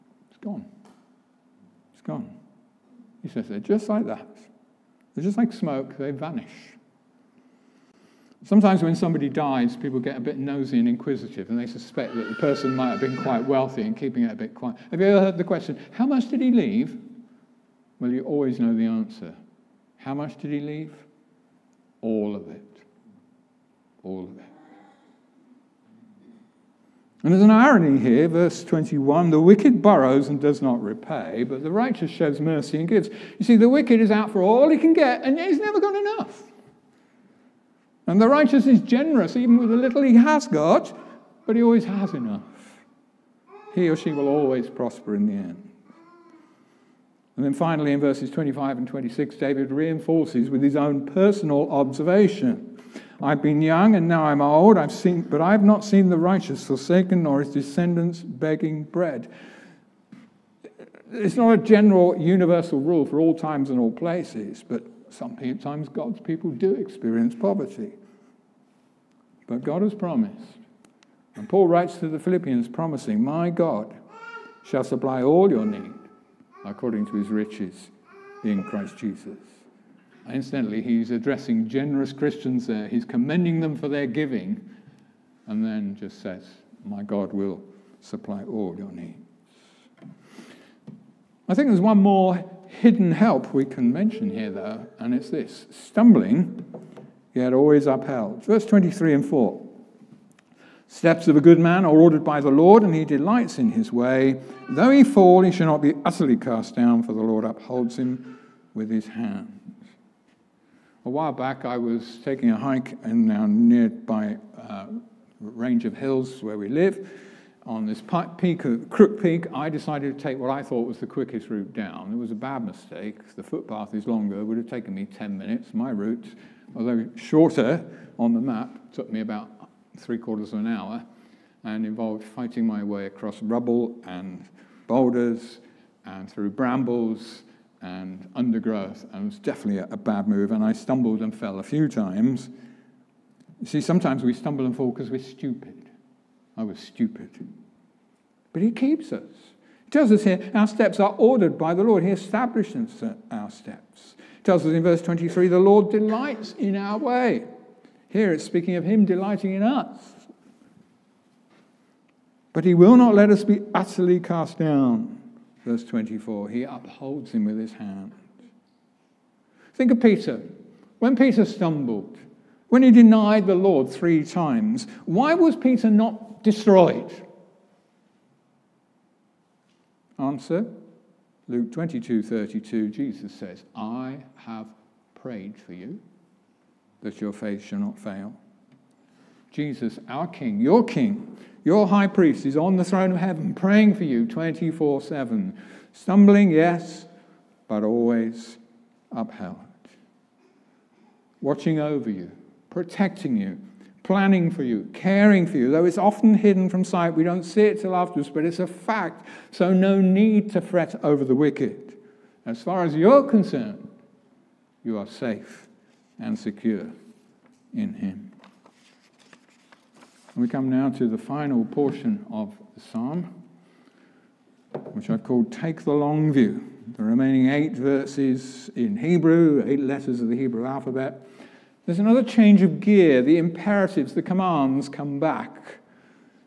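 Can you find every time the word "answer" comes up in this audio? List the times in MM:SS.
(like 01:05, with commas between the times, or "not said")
00:18, 03:00.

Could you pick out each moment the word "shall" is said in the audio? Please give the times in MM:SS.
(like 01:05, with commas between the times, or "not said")
01:14, 01:45, 03:07.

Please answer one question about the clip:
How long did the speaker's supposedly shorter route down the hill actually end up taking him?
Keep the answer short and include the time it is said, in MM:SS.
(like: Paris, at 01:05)
three quarters of an hour, at 02:10.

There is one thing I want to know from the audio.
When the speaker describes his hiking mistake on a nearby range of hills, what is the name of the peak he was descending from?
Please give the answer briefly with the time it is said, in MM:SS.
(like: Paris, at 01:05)
Crook Peak, at 01:58.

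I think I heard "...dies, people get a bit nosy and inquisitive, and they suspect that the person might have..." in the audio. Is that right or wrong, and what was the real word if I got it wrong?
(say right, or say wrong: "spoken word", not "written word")
right.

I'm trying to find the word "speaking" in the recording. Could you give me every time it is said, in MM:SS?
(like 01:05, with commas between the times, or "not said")
02:38.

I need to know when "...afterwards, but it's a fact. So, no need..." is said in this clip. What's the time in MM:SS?
03:27.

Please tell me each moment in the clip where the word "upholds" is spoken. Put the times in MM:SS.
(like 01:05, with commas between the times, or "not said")
01:47, 02:46.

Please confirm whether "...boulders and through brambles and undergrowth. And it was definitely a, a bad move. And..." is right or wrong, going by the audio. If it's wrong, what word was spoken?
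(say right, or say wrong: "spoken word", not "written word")
right.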